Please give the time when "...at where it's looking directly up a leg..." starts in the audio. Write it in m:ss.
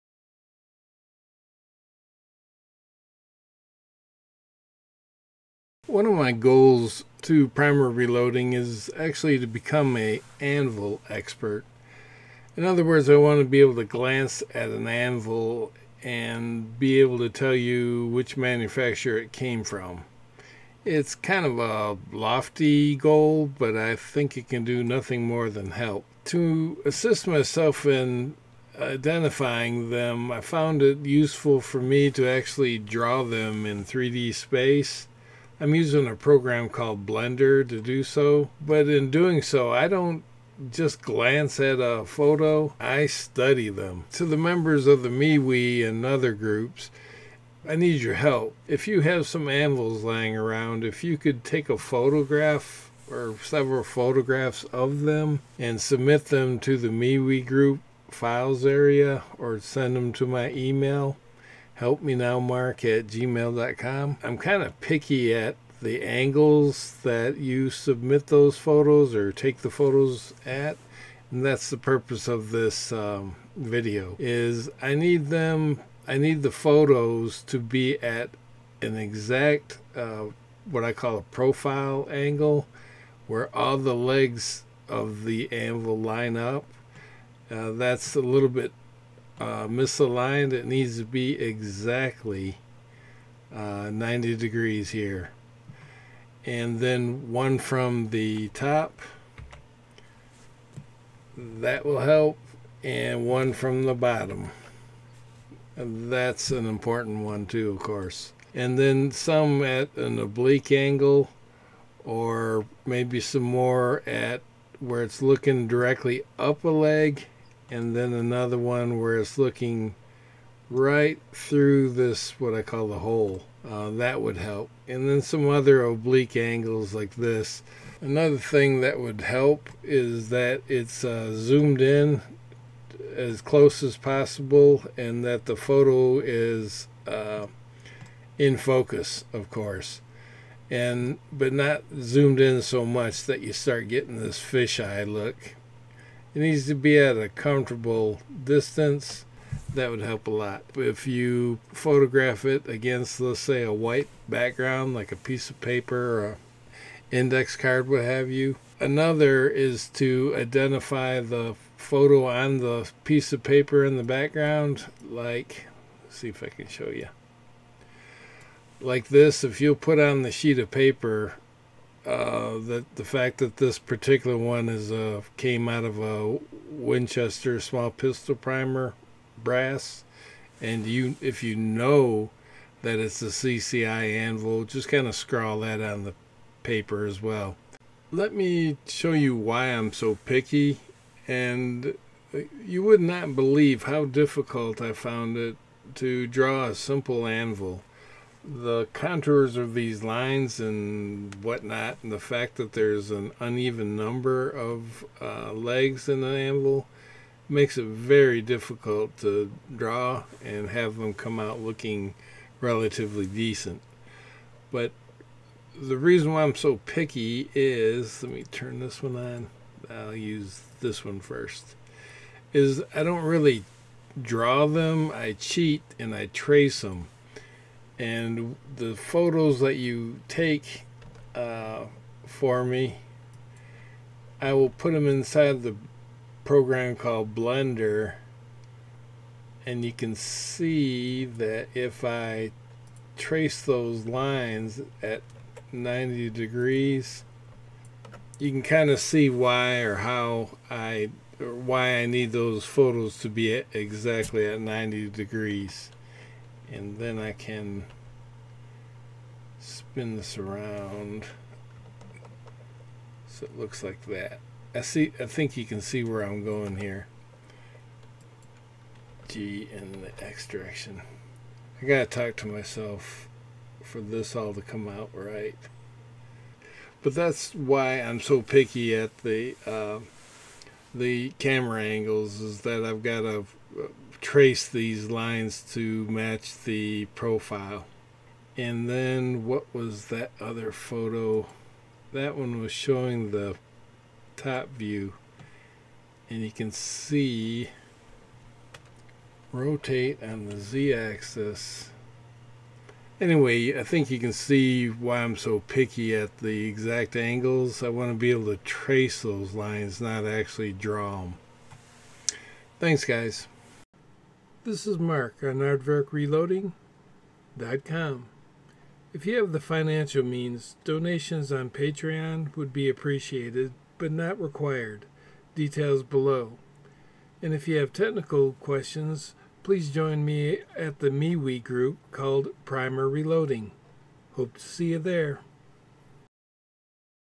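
1:54.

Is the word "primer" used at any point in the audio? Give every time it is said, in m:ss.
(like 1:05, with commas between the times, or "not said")
0:07, 2:58, 5:32.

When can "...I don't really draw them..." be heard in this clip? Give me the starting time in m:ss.
3:42.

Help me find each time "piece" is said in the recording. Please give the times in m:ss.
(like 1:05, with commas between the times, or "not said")
2:35, 2:43.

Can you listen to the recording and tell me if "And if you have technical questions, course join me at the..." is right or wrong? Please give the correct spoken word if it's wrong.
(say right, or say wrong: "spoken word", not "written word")
wrong: "please", not "course".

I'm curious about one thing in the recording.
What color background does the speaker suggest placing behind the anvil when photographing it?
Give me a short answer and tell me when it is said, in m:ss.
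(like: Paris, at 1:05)
White, at 2:33.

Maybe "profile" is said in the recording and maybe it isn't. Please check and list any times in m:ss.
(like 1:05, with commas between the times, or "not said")
1:21, 4:47.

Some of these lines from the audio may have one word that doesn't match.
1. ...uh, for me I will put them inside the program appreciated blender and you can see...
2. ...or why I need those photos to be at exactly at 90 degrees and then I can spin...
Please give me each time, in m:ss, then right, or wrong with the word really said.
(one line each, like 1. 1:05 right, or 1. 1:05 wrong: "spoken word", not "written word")
1. 3:51 wrong: "called", not "appreciated"
2. 4:11 right.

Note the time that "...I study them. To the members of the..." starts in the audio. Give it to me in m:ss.
0:42.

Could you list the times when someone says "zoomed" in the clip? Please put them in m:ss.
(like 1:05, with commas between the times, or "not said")
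2:11, 2:21.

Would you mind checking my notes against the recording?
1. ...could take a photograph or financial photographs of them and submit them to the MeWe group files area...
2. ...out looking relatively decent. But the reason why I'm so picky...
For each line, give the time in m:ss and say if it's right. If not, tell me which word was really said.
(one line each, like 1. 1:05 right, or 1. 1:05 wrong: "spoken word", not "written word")
1. 0:51 wrong: "several", not "financial"
2. 3:31 right.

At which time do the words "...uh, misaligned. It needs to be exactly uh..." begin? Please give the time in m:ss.
1:29.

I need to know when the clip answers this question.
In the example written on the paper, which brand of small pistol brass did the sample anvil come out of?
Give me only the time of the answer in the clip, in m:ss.
2:56.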